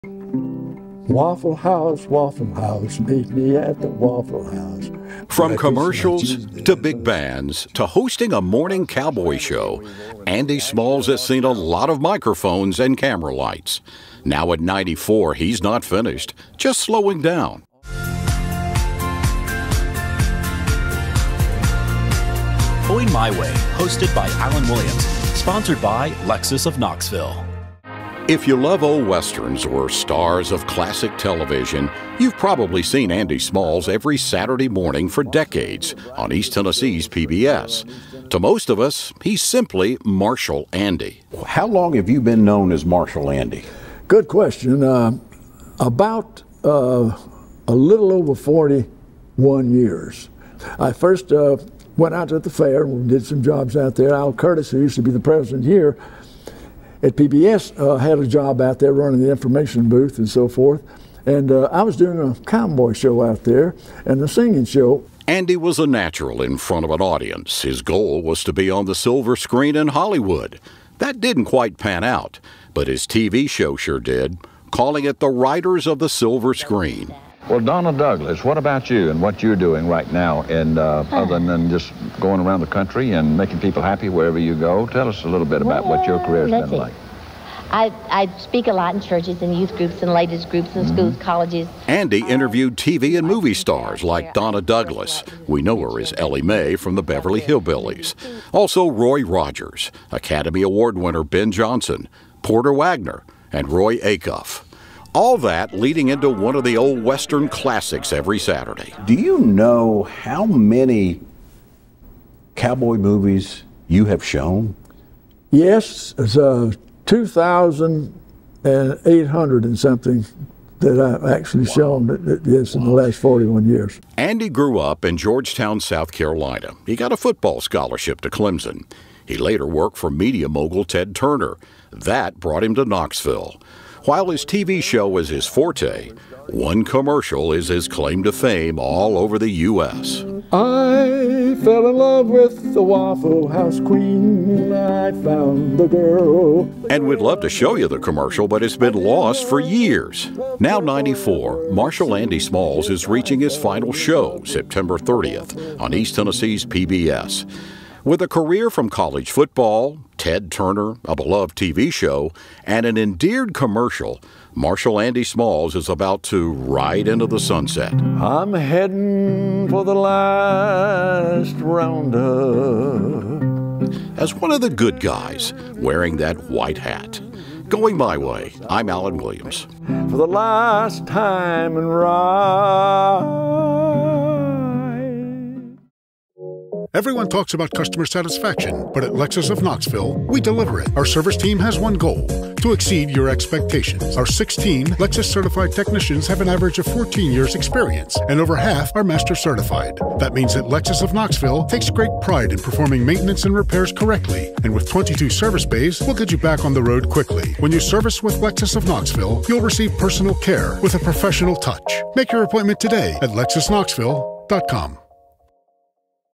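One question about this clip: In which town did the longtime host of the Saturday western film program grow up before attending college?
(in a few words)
Georgetown, South Carolina.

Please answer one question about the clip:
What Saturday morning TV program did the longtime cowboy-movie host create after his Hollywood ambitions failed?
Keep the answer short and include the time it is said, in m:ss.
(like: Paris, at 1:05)
The Riders of the Silver Screen, at 1:15.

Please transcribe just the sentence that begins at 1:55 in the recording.
Yes, it's uh, 2,800 and something that I've actually wow.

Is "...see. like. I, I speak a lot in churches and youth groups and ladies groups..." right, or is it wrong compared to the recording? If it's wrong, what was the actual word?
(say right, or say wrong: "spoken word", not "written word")
right.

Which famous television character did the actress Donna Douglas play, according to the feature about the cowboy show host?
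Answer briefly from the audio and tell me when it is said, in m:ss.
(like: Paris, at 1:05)
Ellie Mae, at 1:36.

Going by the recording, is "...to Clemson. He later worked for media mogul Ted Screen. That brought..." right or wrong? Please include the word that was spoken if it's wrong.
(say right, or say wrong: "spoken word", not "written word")
wrong: "Turner", not "Screen".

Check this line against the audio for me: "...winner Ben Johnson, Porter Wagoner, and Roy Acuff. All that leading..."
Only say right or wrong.
right.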